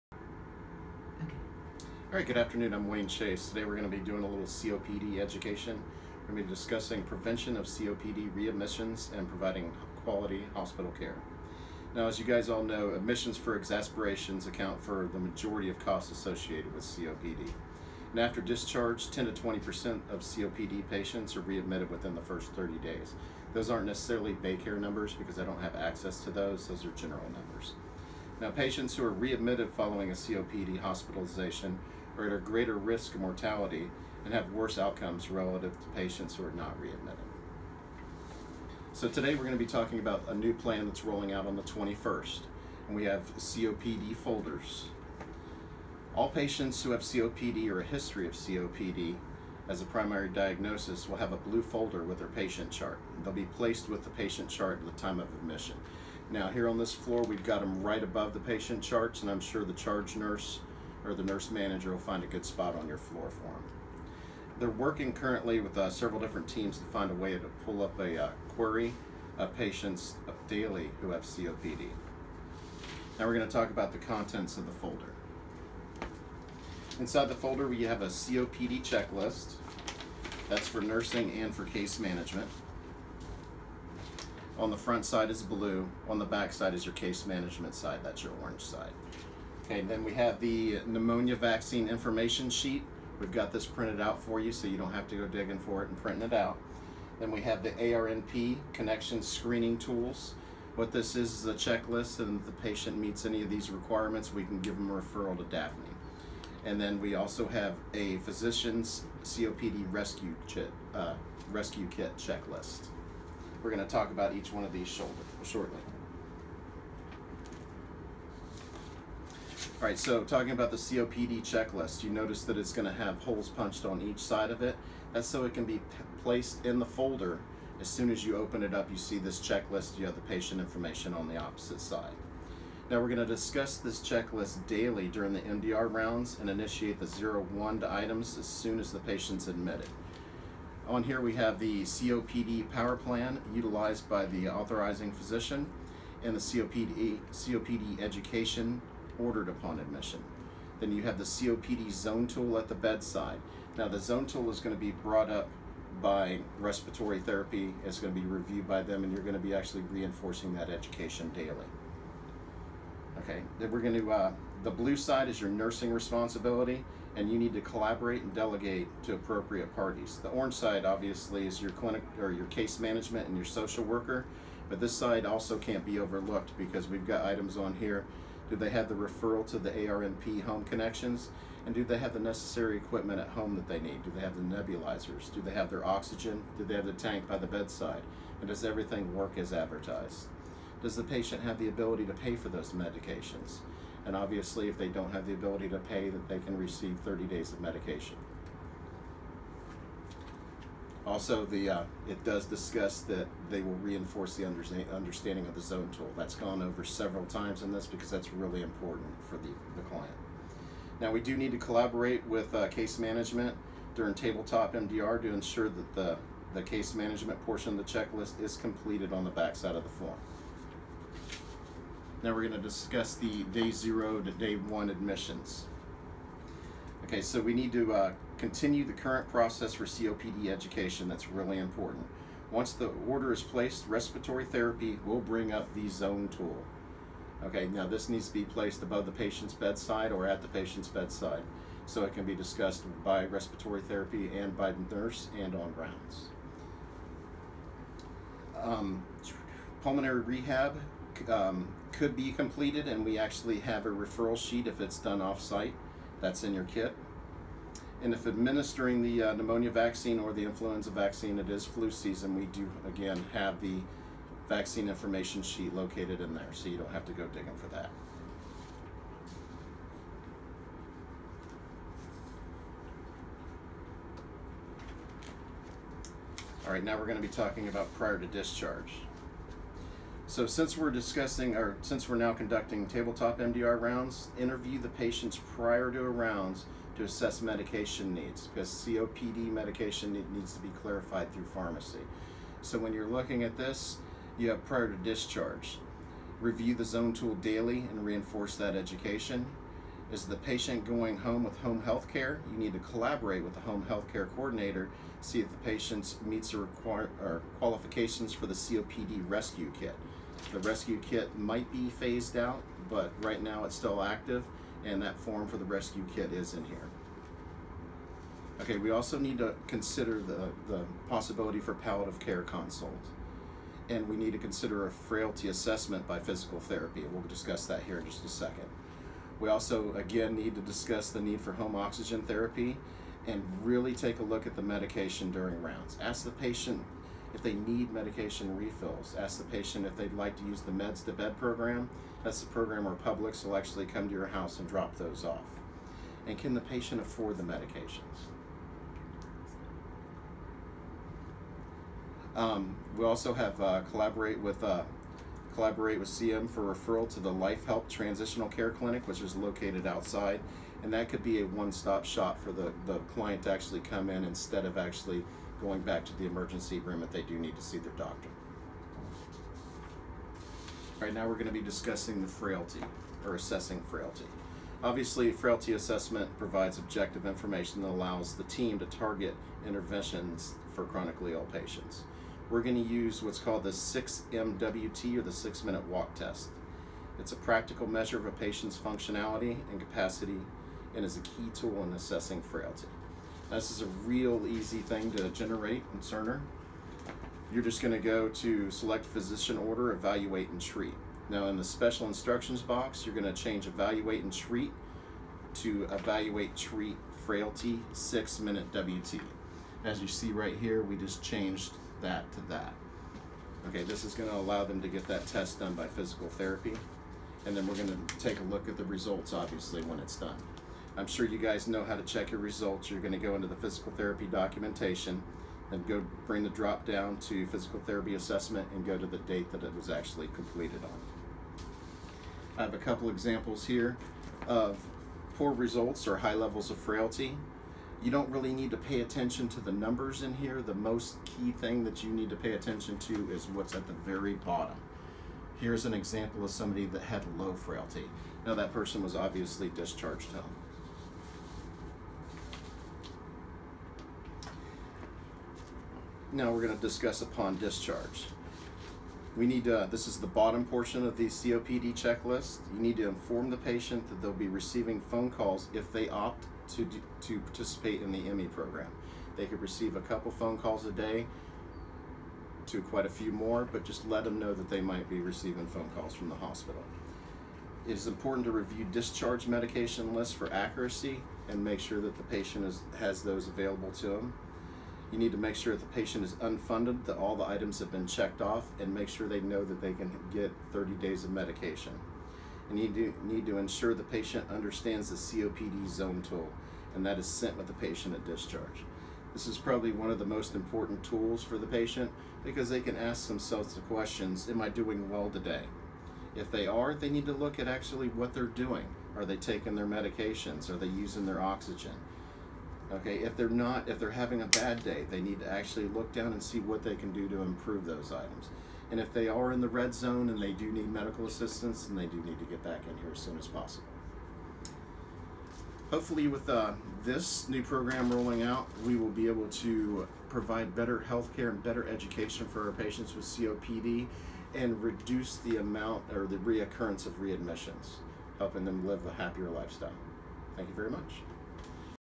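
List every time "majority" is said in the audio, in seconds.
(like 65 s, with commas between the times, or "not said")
15 s.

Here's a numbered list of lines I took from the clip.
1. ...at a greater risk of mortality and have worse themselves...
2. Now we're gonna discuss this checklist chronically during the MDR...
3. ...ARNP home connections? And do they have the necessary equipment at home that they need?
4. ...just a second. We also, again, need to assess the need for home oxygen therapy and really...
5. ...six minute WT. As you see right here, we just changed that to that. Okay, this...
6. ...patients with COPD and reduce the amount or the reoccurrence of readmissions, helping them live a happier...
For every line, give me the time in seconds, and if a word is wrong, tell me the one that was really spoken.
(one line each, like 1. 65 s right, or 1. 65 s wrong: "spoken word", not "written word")
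1. 32 s wrong: "outcomes", not "themselves"
2. 132 s wrong: "daily", not "chronically"
3. 179 s right
4. 328 s wrong: "discuss", not "assess"
5. 407 s right
6. 532 s right.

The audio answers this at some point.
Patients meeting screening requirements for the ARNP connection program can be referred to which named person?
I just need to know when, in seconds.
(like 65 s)
105 s.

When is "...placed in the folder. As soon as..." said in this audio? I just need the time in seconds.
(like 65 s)
126 s.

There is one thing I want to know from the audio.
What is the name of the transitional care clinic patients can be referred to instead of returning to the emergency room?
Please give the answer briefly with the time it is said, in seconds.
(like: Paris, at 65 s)
Life Help Transitional Care Clinic, at 357 s.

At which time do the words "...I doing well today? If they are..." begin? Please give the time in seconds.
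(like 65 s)
504 s.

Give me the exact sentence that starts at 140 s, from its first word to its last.
On here we have the COPD power plan utilized by the authorizing physician and the COPD, COPD education ordered upon admission.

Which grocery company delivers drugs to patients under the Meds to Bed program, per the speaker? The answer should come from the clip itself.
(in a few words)
Publix.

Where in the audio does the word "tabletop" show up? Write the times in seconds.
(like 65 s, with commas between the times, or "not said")
214 s, 282 s.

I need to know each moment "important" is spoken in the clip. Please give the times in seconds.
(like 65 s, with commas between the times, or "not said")
208 s, 231 s, 478 s, 500 s.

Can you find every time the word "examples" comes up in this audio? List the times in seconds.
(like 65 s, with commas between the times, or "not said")
433 s, 445 s.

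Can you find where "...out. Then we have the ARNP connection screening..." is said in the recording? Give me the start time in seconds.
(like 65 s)
96 s.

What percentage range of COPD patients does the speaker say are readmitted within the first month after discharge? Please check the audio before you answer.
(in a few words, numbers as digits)
10 to 20%.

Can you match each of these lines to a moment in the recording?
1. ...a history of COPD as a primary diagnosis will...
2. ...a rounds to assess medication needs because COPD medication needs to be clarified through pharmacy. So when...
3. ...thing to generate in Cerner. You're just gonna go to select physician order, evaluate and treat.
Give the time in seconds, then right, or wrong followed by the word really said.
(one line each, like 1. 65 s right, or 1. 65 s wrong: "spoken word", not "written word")
1. 47 s right
2. 285 s right
3. 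394 s right.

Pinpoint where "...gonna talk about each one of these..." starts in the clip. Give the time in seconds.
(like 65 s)
113 s.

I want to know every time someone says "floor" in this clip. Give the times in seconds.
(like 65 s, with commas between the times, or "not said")
56 s, 62 s.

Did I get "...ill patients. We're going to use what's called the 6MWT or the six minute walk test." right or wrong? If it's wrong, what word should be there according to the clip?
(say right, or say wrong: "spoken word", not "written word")
right.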